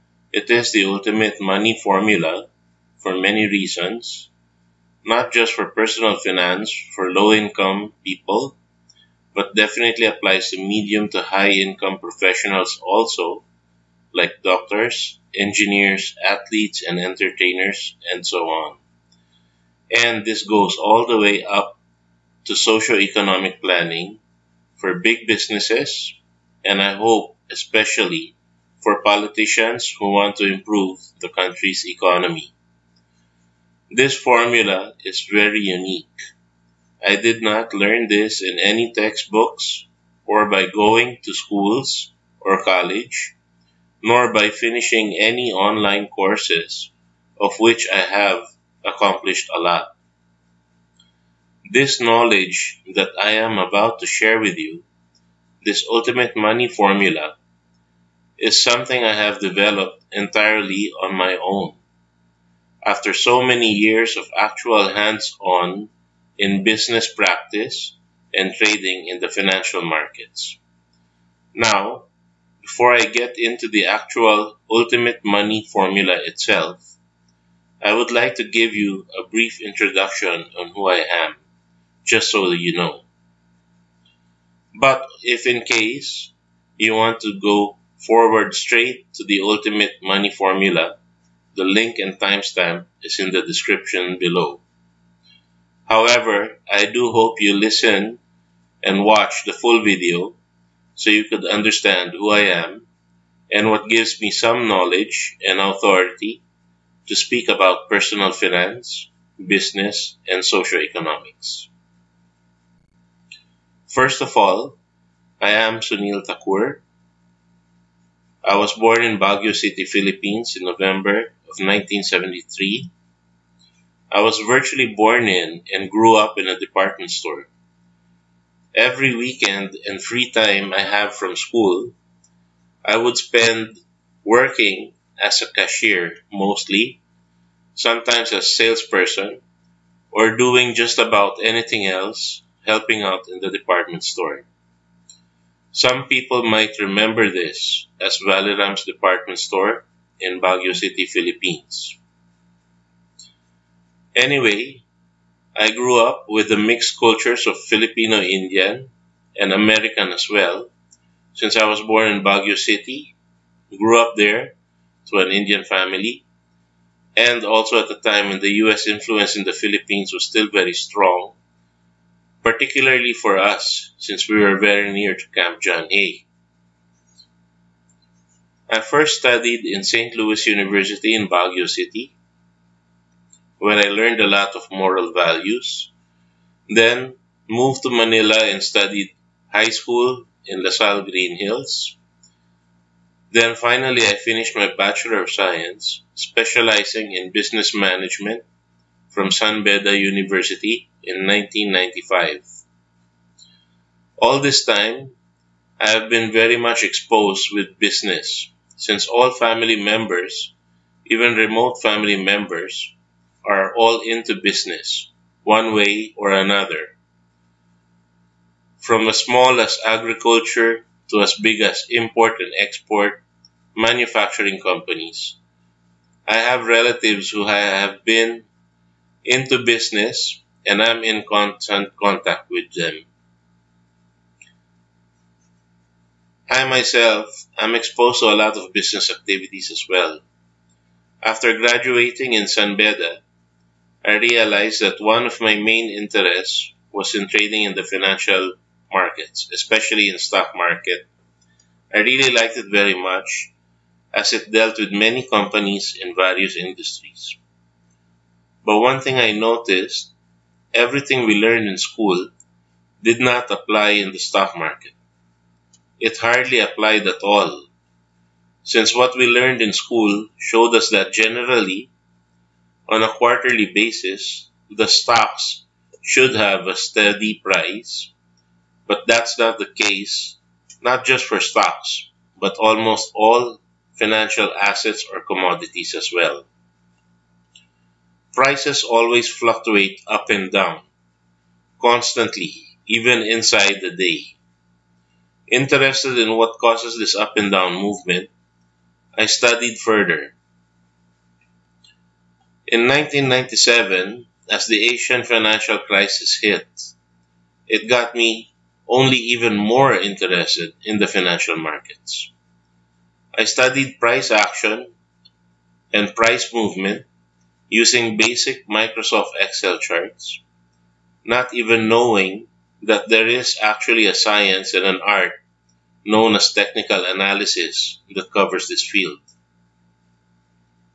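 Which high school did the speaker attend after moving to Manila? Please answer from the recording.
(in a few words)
LaSalle Green Hills.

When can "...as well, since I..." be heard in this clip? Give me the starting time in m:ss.
2:40.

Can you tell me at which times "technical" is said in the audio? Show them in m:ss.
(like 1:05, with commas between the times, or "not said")
5:26.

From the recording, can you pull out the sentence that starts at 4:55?
Interested in what causes this up and down movement, I studied further.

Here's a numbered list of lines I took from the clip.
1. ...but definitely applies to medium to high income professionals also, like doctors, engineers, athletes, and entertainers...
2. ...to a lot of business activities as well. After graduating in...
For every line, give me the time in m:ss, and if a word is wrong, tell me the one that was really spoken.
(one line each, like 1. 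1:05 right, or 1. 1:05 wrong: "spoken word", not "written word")
1. 0:09 right
2. 3:58 right.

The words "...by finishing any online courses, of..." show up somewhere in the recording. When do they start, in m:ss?
0:44.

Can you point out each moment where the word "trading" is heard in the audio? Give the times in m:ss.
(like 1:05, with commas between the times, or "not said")
1:08, 4:07.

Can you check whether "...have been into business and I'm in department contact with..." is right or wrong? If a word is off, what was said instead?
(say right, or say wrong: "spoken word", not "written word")
wrong: "constant", not "department".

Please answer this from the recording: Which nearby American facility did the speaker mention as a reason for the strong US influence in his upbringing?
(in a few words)
Camp John Hay.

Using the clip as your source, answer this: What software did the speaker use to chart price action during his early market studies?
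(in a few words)
Microsoft Excel.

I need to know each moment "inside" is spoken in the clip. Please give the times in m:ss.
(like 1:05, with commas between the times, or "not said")
4:53.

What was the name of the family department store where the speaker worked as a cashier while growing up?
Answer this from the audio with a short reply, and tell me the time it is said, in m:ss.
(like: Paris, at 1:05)
Valeram's department store, at 2:28.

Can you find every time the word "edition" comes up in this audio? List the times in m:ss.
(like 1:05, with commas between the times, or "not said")
not said.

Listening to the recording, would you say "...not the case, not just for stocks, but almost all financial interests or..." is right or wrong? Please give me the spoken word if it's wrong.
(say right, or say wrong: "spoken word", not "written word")
wrong: "assets", not "interests".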